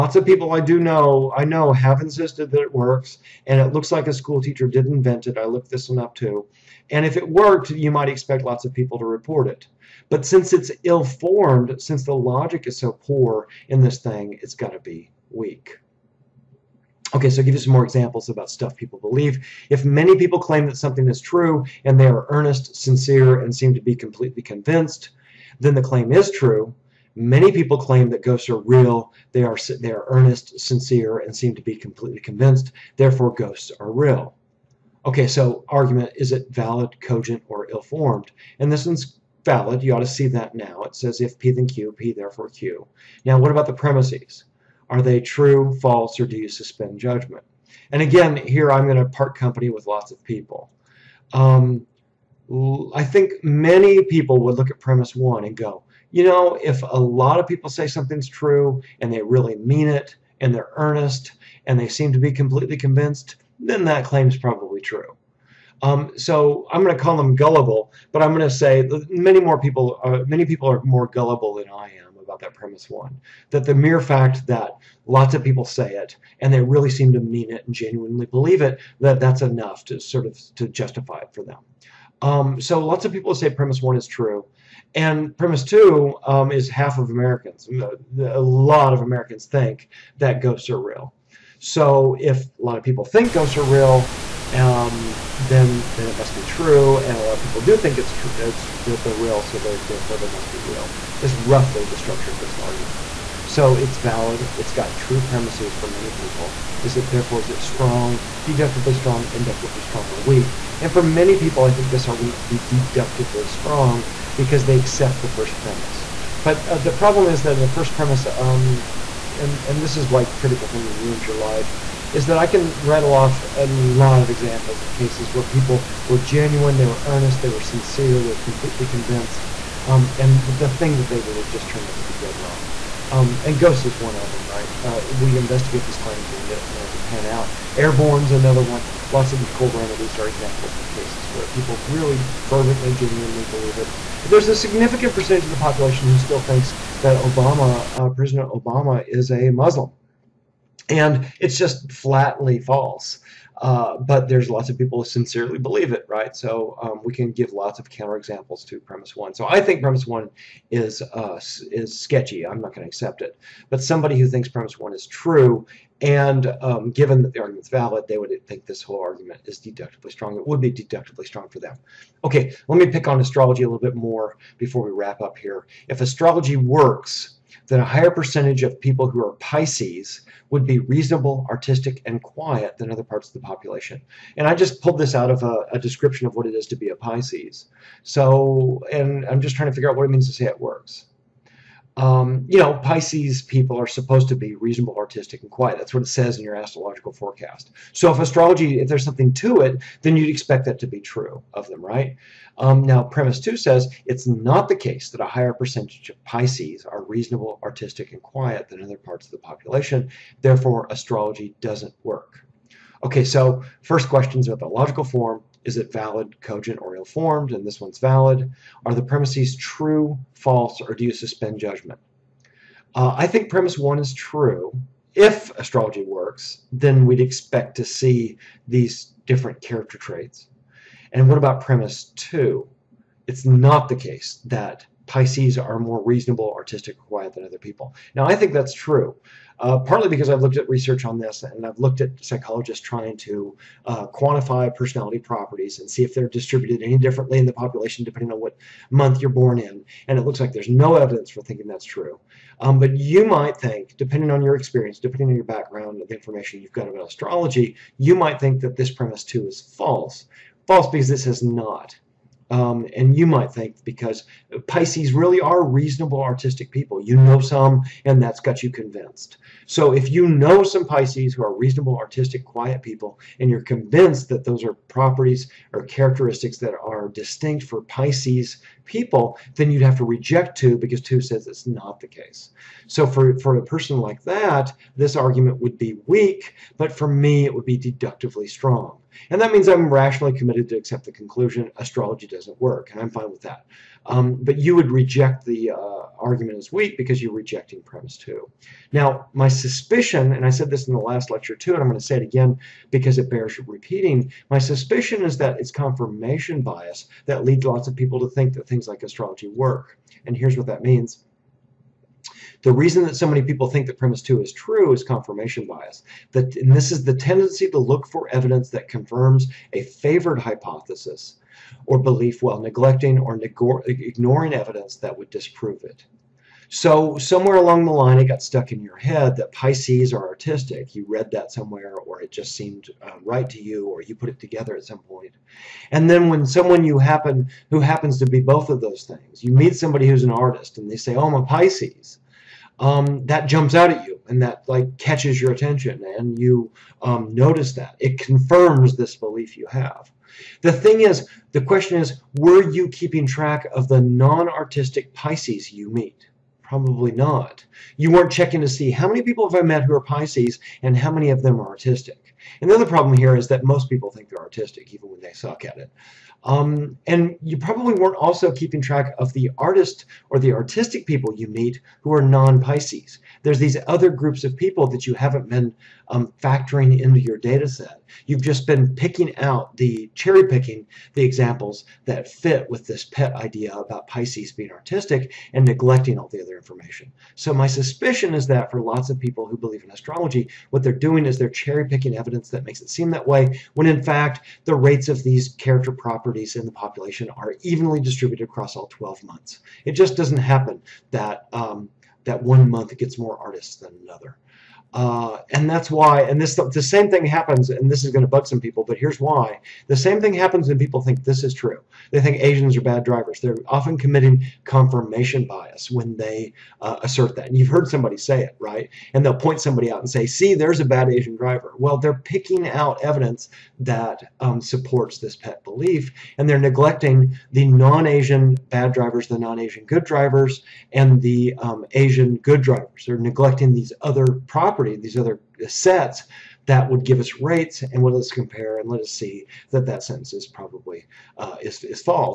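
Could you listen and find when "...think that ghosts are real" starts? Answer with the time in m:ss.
1:29.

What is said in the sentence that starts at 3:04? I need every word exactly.
And I just pulled this out of a, a description of what it is to be a Pisces.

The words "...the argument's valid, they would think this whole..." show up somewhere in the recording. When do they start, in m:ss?
2:47.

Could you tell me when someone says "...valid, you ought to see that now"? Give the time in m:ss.
0:39.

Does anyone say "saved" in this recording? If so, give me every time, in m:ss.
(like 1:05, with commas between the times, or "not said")
not said.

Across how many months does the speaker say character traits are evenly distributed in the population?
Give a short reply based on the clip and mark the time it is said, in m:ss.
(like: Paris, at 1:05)
12, at 6:38.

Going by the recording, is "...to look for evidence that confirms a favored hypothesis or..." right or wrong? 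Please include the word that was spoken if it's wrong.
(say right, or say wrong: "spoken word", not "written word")
right.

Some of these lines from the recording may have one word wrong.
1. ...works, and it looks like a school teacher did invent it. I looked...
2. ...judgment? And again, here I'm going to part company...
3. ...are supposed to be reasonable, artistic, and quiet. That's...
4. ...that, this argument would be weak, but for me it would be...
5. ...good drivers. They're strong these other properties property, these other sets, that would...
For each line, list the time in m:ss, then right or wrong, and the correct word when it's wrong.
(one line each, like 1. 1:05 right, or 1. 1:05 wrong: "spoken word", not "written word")
1. 0:02 right
2. 0:46 right
3. 3:13 right
4. 4:44 right
5. 7:12 wrong: "neglecting", not "strong".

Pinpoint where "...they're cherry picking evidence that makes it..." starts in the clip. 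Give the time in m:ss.
6:31.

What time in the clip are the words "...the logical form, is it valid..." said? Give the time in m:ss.
3:34.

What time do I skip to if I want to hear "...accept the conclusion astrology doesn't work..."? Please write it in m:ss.
4:50.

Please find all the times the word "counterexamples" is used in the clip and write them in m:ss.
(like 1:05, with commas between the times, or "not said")
2:37.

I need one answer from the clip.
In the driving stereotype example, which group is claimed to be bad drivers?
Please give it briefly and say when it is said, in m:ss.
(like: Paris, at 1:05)
Asians, at 6:52.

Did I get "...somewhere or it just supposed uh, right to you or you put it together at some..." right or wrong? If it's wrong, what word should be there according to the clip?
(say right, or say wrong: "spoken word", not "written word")
wrong: "seemed", not "supposed".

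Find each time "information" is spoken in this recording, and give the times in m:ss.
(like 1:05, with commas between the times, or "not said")
4:16, 6:26.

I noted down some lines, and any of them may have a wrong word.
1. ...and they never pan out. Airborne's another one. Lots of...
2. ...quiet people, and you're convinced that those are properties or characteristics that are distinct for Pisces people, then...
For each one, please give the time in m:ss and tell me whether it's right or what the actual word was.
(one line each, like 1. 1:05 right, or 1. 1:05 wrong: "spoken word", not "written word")
1. 2:16 right
2. 4:32 right.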